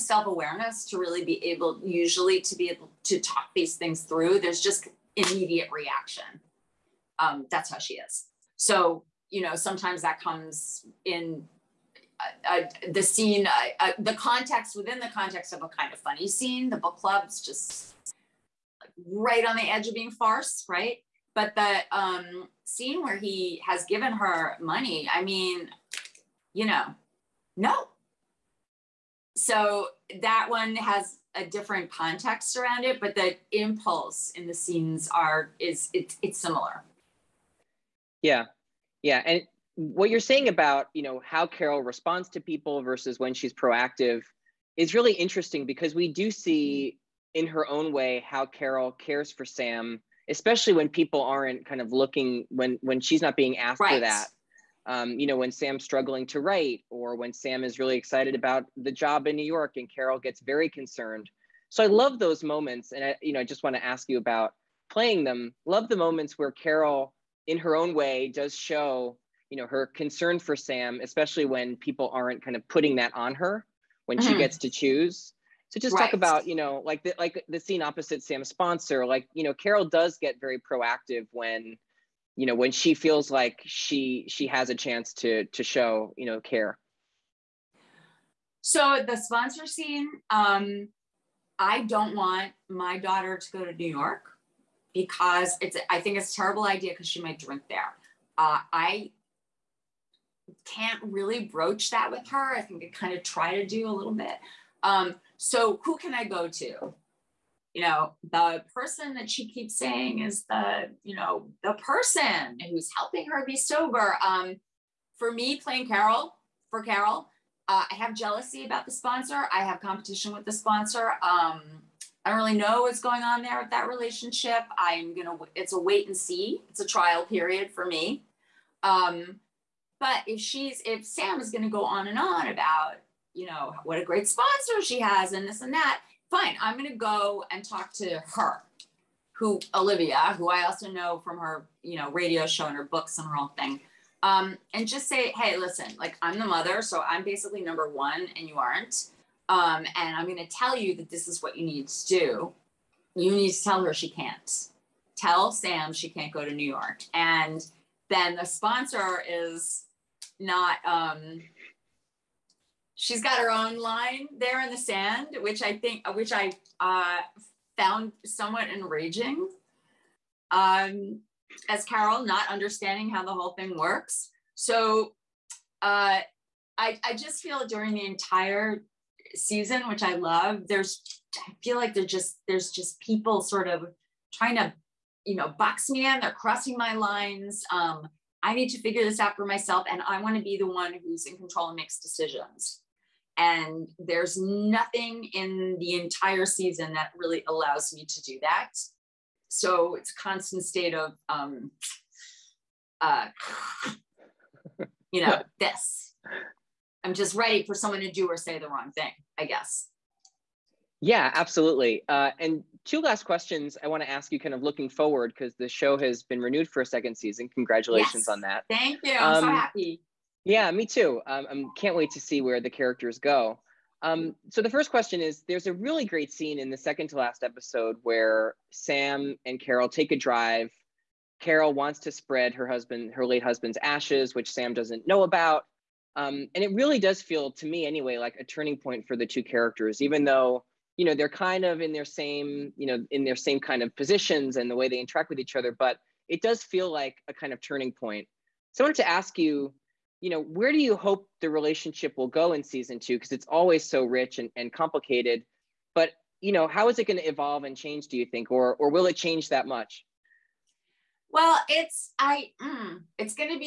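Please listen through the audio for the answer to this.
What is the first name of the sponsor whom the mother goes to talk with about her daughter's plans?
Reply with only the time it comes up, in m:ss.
2:19.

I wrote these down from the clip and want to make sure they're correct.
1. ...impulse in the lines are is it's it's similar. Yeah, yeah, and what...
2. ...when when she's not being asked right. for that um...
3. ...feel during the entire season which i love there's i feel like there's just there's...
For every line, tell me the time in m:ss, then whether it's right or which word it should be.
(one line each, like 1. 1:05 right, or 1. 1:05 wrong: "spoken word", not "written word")
1. 0:33 wrong: "scenes", not "lines"
2. 0:52 right
3. 2:57 right.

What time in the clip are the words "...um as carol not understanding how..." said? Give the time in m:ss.
2:50.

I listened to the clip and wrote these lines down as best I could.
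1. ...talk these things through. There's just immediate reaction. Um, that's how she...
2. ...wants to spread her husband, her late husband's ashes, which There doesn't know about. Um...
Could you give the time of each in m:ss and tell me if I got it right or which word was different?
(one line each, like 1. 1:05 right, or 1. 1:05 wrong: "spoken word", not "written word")
1. 0:03 right
2. 3:51 wrong: "Sam", not "There".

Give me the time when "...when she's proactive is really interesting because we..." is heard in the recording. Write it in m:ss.
0:43.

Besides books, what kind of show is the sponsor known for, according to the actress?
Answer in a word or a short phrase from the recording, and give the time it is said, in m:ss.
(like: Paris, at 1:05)
radio show, at 2:22.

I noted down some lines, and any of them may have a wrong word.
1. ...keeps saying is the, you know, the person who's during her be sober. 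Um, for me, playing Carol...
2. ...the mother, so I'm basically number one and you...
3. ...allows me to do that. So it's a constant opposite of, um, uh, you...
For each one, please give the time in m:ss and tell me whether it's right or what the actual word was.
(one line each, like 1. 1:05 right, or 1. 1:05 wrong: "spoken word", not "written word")
1. 1:49 wrong: "helping", not "during"
2. 2:26 right
3. 3:17 wrong: "state", not "opposite".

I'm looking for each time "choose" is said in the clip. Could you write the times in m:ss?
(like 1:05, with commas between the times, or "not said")
1:14.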